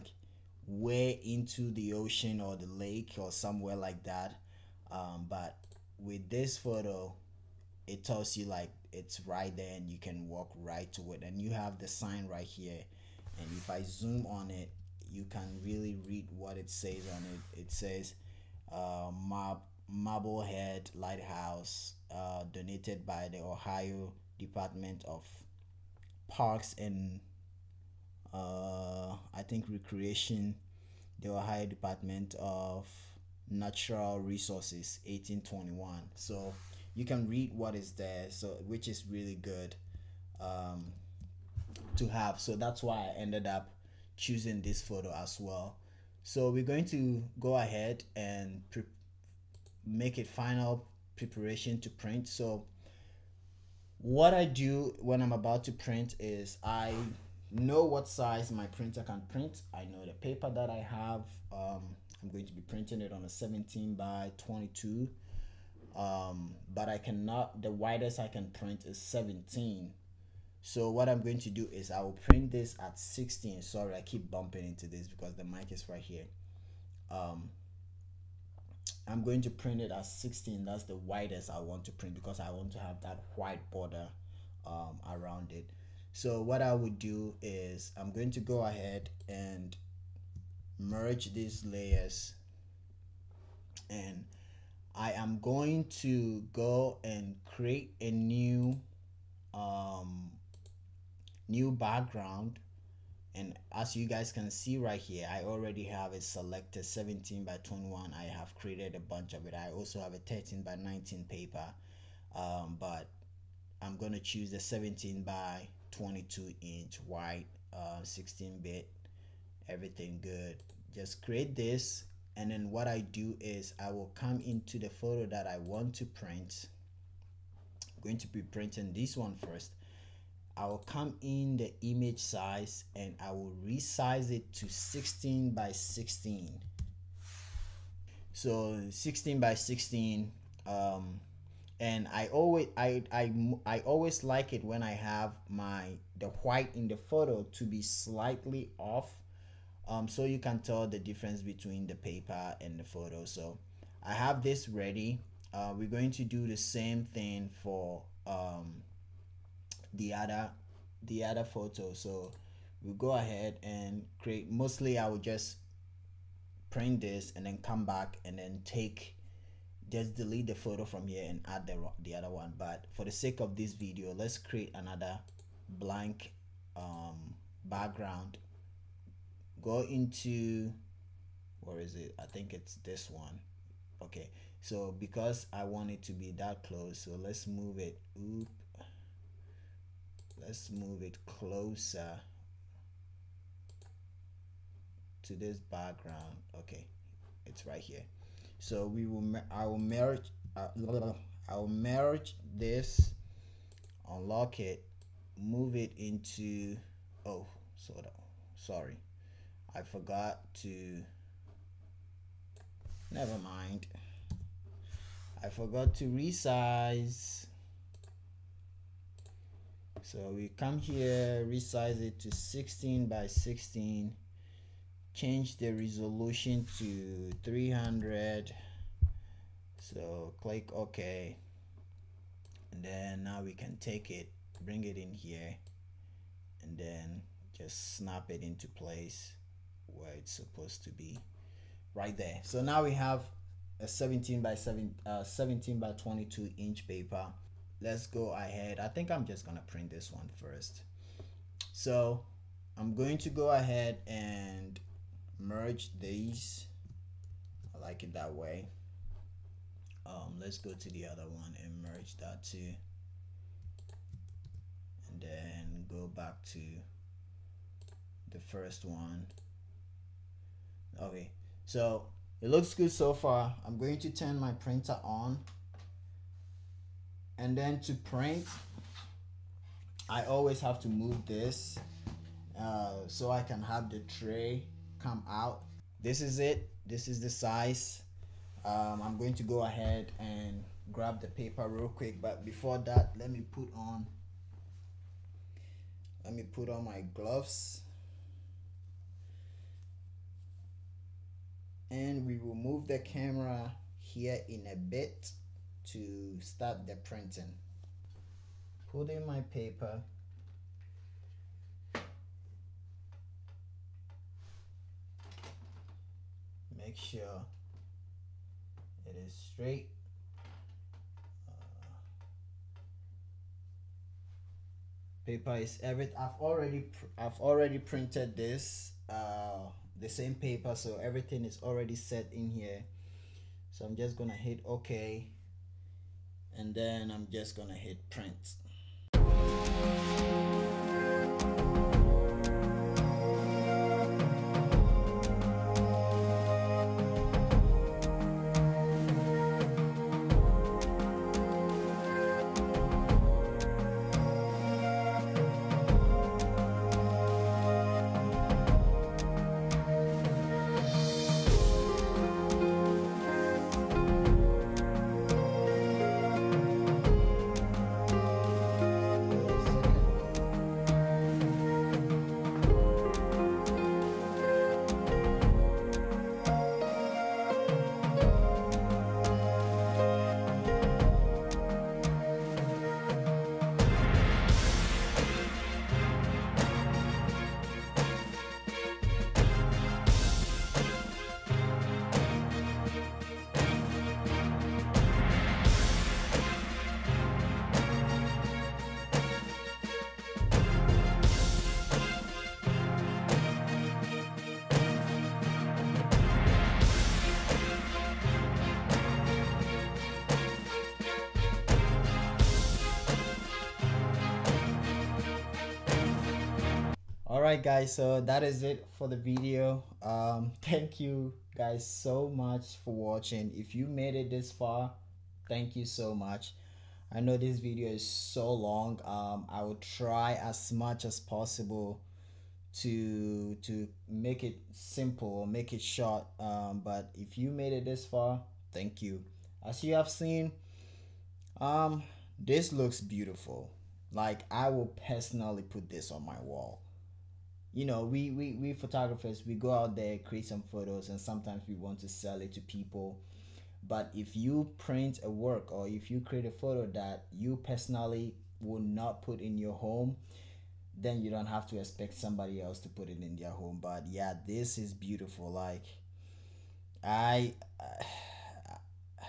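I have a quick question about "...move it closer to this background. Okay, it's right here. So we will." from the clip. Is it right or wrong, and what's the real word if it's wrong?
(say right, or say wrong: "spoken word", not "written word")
right.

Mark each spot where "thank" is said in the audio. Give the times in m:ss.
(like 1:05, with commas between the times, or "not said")
7:00, 7:05, 7:18.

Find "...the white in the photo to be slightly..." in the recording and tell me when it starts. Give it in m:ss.
2:26.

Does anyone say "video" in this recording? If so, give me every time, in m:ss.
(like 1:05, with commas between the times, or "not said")
2:53, 6:59, 7:07.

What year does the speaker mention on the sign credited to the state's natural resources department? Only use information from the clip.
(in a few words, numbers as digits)
1821.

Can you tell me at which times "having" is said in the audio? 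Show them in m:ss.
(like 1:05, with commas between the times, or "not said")
not said.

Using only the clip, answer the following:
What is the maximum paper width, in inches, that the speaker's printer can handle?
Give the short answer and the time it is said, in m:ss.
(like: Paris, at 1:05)
17, at 1:07.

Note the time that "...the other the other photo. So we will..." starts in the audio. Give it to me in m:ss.
2:39.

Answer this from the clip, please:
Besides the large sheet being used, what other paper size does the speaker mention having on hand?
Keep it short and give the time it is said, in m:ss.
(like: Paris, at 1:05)
13 by 19, at 1:50.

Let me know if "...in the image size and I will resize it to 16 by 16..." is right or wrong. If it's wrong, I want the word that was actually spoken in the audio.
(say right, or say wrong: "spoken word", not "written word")
right.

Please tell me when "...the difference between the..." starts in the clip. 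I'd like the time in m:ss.
2:30.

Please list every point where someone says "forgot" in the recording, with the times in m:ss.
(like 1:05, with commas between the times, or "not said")
3:29, 3:35.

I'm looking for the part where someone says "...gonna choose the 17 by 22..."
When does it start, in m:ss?
1:53.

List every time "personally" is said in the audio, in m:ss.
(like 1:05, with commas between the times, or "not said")
7:25, 7:37.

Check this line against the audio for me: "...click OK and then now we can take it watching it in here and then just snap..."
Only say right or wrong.
wrong.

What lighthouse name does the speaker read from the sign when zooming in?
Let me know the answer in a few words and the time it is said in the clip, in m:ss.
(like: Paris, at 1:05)
Marblehead Lighthouse, at 0:19.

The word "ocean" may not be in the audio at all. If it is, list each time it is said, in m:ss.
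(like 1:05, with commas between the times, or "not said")
0:01.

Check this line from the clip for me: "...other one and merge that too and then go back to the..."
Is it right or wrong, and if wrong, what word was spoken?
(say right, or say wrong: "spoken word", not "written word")
right.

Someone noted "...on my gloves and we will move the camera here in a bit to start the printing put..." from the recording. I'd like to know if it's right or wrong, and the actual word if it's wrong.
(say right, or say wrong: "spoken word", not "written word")
right.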